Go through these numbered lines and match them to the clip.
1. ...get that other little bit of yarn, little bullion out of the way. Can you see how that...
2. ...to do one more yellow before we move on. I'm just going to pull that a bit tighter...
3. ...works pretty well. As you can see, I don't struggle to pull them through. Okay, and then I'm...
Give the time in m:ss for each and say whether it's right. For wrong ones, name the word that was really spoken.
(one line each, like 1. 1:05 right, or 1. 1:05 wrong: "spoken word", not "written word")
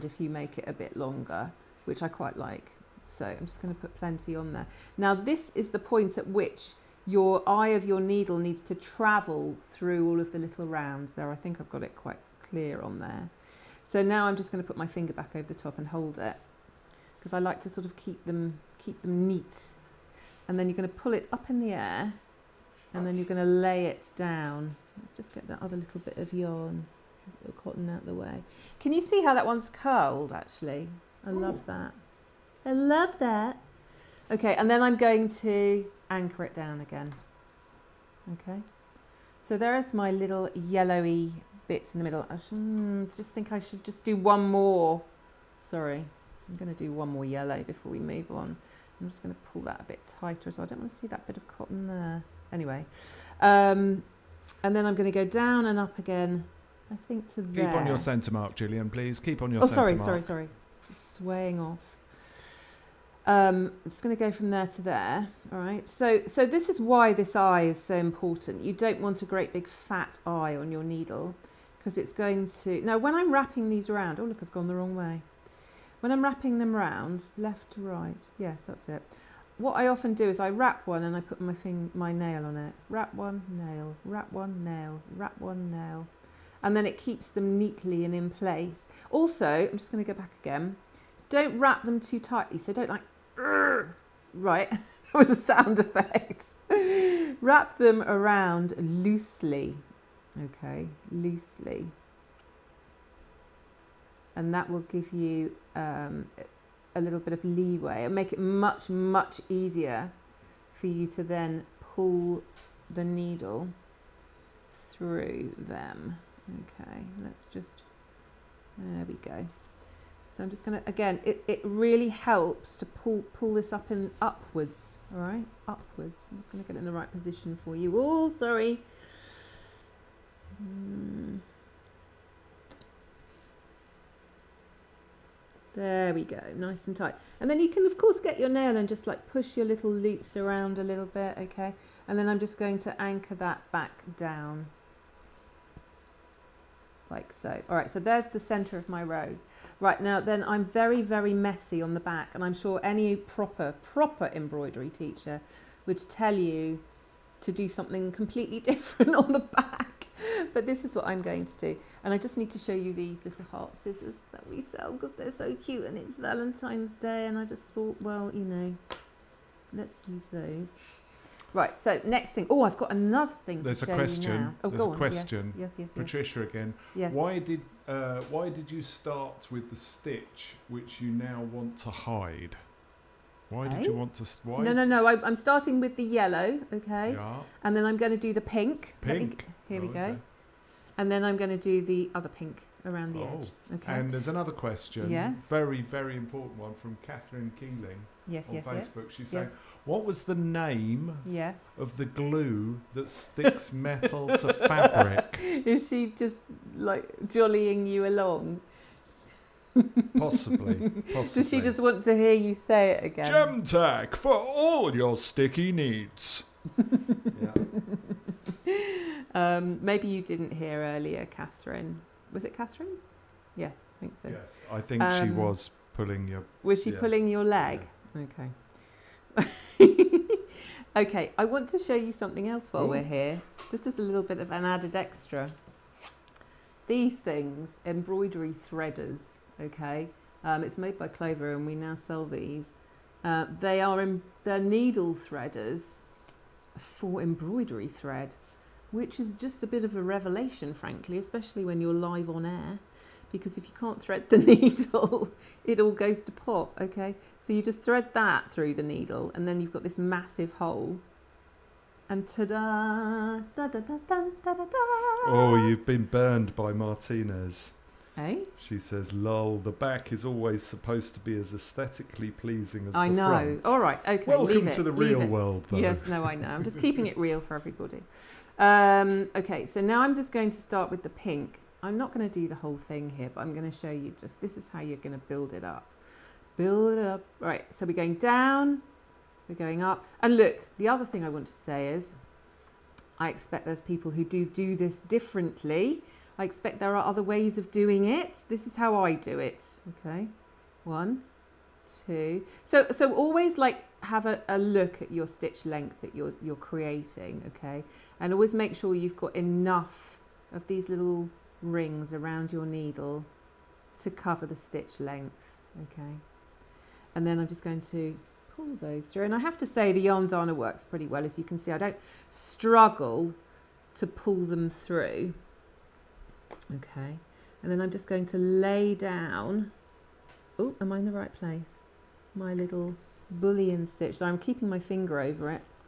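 1. 0:25 wrong: "cotton", not "bullion"
2. 0:46 right
3. 5:20 right.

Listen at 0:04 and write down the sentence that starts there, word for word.
Now this is the point at which your eye of your needle needs to travel through all of the little rounds there.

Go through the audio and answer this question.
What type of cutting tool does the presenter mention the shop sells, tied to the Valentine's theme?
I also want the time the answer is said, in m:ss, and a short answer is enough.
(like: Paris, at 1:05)
heart scissors, at 2:43.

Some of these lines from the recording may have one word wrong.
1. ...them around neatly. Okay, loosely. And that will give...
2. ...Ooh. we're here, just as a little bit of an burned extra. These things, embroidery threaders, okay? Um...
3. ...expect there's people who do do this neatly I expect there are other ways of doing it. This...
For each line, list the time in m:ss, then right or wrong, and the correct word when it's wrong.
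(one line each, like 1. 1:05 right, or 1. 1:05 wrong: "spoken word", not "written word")
1. 1:37 wrong: "loosely", not "neatly"
2. 3:52 wrong: "added", not "burned"
3. 4:53 wrong: "differently", not "neatly".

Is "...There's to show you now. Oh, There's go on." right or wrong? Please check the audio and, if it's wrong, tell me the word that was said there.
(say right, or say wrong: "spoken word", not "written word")
right.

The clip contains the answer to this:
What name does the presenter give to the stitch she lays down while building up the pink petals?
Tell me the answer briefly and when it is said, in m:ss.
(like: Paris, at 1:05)
bullion stitch, at 5:33.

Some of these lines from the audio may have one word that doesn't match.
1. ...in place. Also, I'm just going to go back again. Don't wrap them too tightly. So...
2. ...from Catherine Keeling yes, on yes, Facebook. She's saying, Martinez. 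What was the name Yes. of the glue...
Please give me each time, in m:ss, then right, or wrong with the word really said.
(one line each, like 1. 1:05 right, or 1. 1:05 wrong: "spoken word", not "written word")
1. 1:28 right
2. 3:16 wrong: "Yes", not "Martinez".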